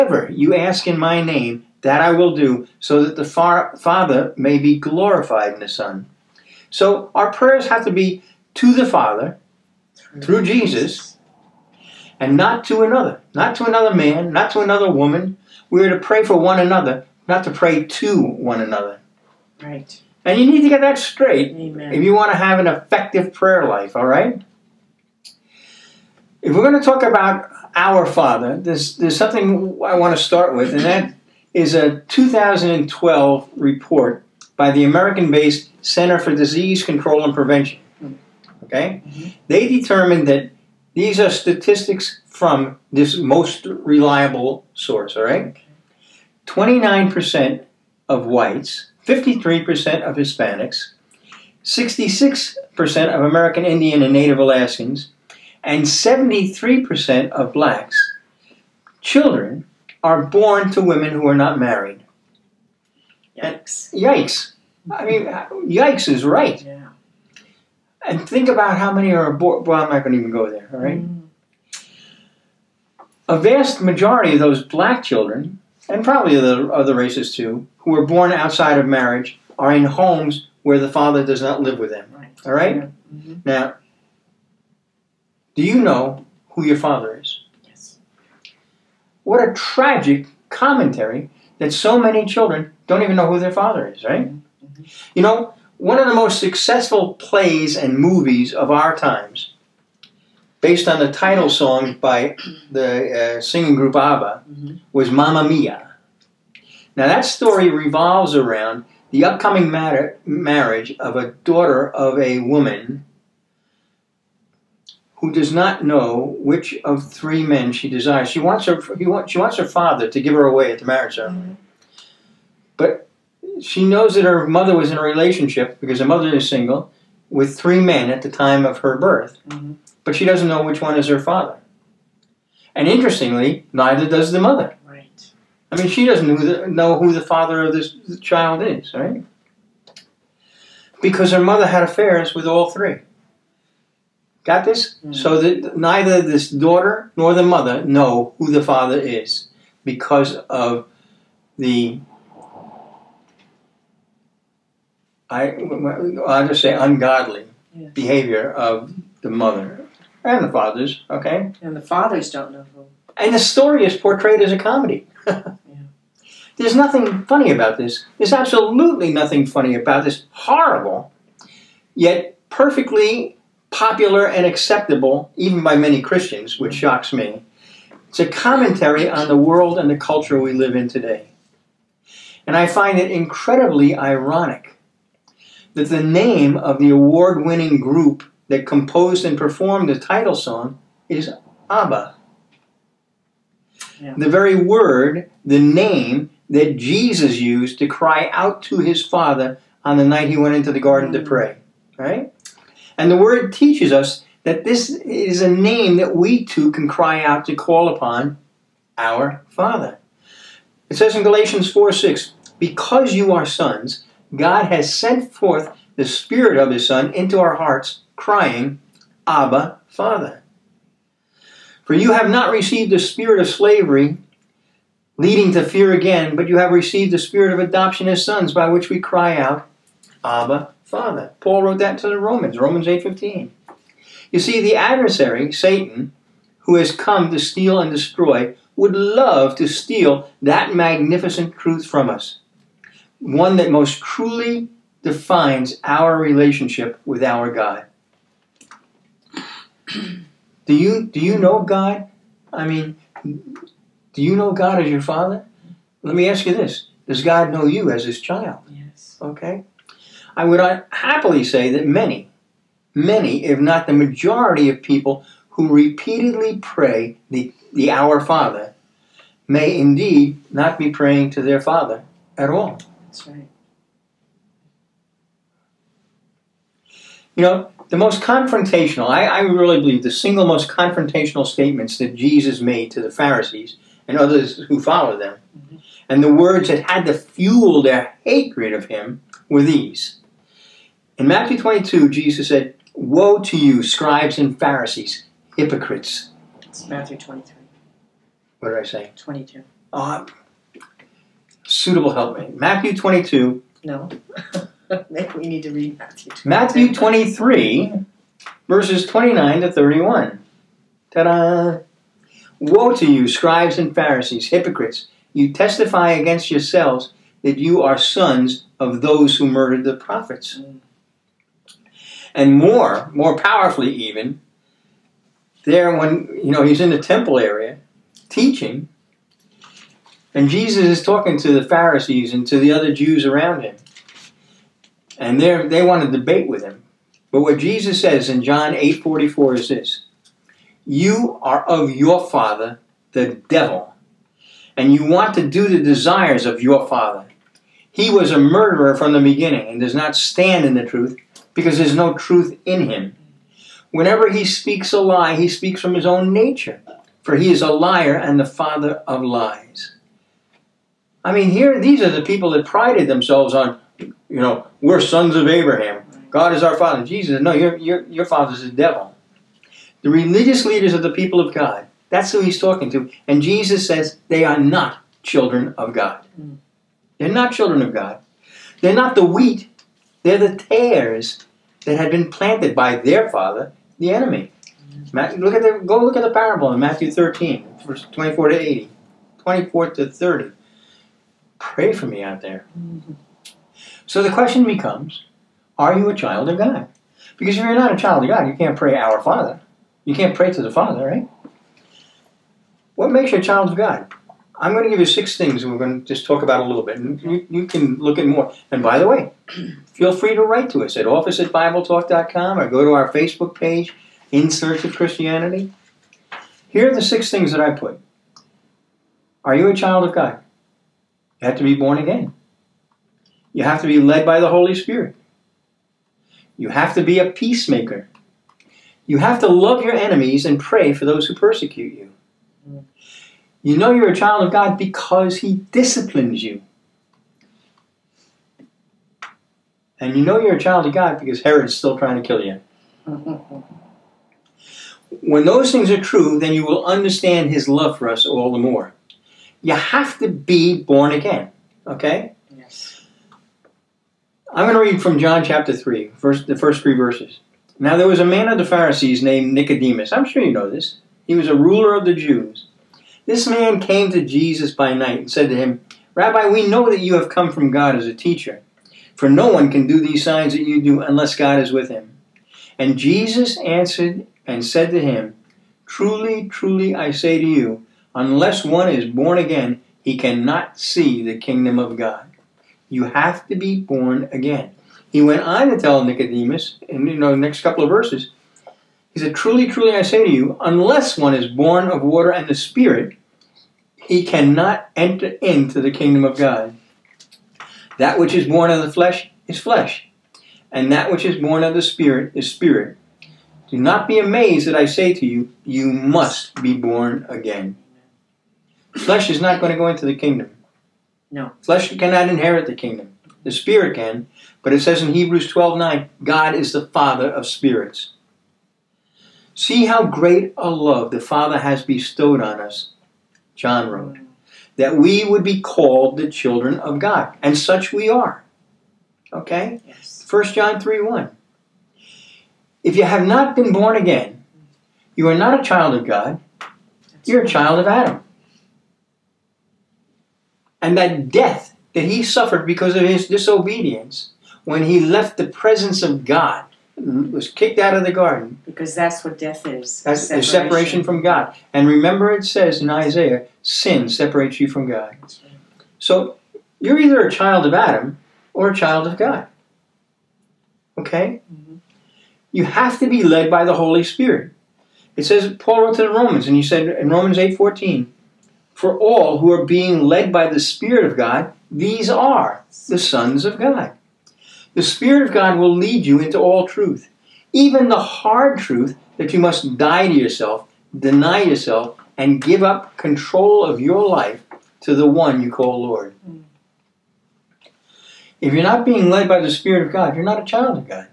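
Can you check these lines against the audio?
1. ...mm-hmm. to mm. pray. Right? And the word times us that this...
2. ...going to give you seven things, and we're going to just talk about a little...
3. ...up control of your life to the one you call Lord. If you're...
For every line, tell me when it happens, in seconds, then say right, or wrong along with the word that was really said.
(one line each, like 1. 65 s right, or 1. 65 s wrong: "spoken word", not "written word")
1. 201 s wrong: "teaches", not "times"
2. 404 s wrong: "six", not "seven"
3. 582 s right.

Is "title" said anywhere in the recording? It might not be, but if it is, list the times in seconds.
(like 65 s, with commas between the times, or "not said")
101 s, 189 s.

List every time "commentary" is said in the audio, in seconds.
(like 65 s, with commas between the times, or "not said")
90 s, 178 s.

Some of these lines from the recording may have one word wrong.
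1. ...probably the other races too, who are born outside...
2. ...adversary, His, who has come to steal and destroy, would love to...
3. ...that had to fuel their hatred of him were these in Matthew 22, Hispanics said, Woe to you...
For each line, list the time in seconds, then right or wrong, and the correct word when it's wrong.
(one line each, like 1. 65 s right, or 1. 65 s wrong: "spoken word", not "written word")
1. 76 s right
2. 234 s wrong: "Satan", not "His"
3. 286 s wrong: "Jesus", not "Hispanics".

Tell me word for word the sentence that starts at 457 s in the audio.
Now there was a man of the Pharisees named Nicodemus.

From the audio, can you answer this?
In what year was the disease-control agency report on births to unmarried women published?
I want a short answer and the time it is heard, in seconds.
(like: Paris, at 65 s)
2012, at 32 s.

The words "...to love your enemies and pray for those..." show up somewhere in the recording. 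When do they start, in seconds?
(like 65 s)
429 s.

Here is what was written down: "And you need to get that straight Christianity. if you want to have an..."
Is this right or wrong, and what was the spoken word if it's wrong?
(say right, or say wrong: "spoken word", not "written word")
wrong: "Amen", not "Christianity".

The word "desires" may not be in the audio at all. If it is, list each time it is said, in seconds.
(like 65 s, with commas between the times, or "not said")
117 s, 345 s.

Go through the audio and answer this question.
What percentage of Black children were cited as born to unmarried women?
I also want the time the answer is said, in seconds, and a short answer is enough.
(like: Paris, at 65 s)
73%, at 55 s.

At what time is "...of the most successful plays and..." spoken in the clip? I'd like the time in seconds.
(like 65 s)
95 s.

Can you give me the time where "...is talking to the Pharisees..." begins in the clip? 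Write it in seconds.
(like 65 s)
330 s.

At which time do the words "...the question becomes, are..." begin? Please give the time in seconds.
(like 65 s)
394 s.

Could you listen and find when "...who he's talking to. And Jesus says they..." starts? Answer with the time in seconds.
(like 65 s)
372 s.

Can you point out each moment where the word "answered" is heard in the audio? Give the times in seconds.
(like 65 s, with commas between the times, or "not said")
473 s.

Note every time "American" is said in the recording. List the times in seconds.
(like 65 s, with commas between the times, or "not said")
34 s, 53 s.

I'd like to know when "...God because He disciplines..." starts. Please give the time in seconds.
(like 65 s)
434 s.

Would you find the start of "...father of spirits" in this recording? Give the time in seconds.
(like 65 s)
516 s.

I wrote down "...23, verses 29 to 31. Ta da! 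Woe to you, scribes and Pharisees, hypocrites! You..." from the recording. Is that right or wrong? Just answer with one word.
right.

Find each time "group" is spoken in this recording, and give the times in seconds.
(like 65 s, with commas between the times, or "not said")
103 s, 187 s.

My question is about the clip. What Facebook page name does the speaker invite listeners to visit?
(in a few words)
In Search of Christianity.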